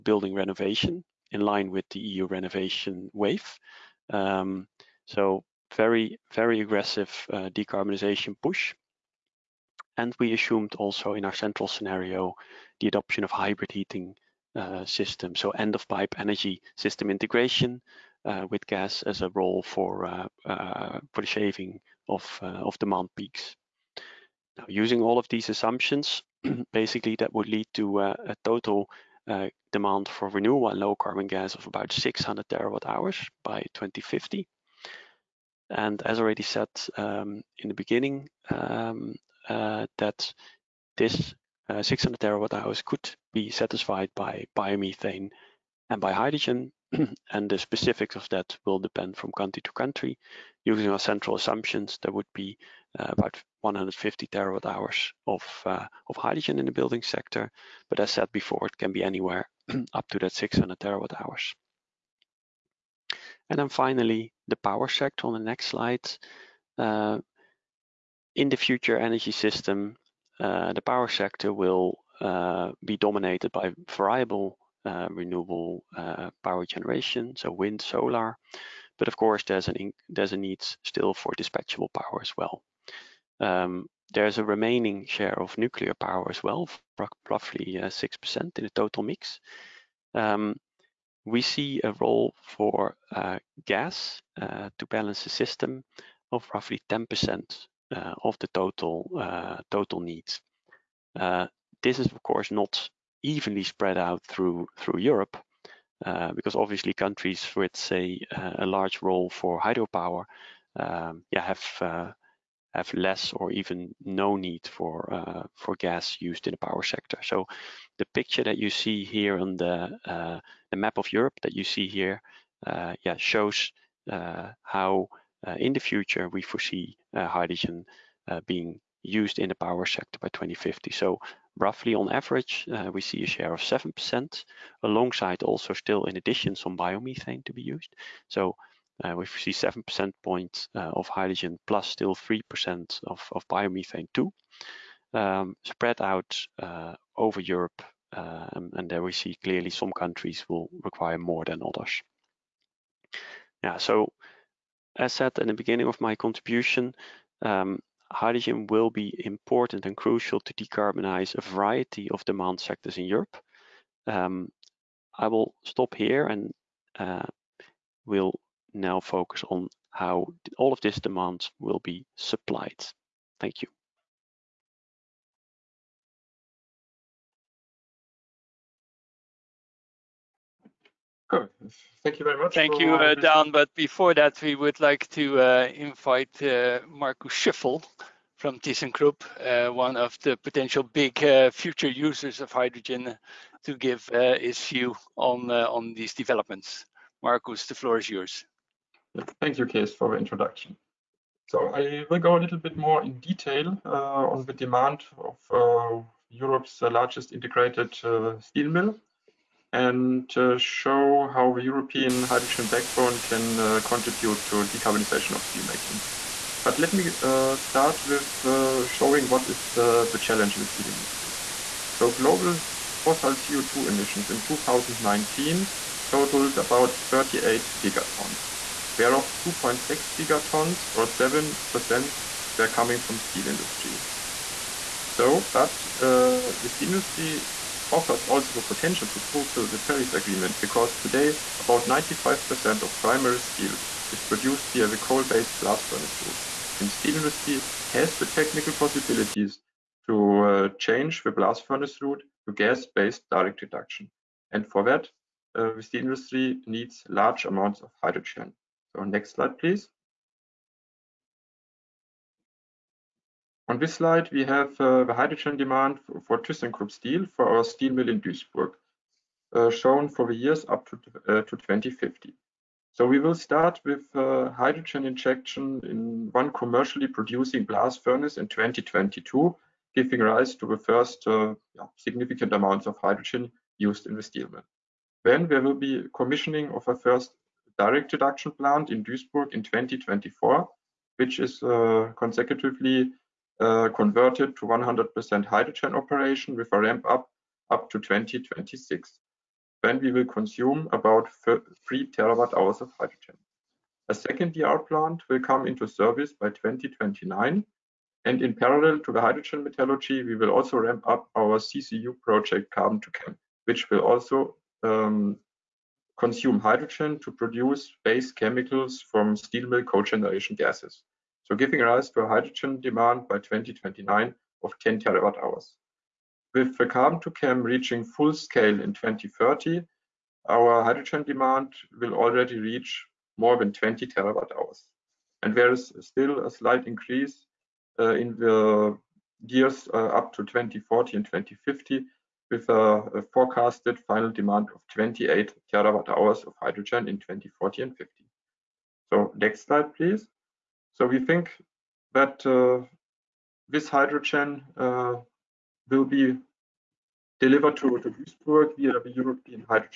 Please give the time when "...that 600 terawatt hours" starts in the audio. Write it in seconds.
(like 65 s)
60 s.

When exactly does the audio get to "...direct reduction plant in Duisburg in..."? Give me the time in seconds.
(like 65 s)
287 s.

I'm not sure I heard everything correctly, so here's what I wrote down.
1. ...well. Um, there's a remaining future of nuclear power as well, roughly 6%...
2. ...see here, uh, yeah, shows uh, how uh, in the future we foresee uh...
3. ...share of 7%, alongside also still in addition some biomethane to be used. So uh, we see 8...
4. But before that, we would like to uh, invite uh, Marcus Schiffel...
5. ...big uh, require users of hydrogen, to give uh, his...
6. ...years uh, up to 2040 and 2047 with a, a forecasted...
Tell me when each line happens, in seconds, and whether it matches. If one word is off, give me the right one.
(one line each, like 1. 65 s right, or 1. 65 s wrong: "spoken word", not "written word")
1. 82 s wrong: "share", not "future"
2. 121 s right
3. 133 s wrong: "7", not "8"
4. 183 s right
5. 190 s wrong: "future", not "require"
6. 339 s wrong: "2050", not "2047".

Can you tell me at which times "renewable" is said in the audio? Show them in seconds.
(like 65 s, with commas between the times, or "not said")
30 s, 75 s.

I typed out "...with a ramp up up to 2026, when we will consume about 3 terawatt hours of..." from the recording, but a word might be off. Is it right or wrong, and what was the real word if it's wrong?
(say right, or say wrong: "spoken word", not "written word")
right.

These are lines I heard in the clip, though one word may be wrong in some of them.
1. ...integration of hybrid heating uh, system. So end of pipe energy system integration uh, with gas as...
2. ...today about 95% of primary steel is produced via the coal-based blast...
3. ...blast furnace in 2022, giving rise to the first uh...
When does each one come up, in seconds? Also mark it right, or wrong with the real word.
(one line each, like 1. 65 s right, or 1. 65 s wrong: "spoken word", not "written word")
1. 12 s wrong: "adoption", not "integration"
2. 240 s right
3. 277 s right.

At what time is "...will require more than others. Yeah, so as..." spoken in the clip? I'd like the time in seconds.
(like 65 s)
150 s.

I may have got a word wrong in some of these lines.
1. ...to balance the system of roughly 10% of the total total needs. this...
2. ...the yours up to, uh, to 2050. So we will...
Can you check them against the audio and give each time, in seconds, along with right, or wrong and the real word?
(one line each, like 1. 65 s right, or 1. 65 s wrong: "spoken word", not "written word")
1. 94 s right
2. 270 s wrong: "years", not "yours".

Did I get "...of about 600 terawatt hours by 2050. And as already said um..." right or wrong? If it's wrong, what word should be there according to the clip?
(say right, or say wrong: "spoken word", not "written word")
right.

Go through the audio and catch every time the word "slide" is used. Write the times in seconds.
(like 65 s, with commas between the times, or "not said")
65 s, 259 s, 263 s, 349 s.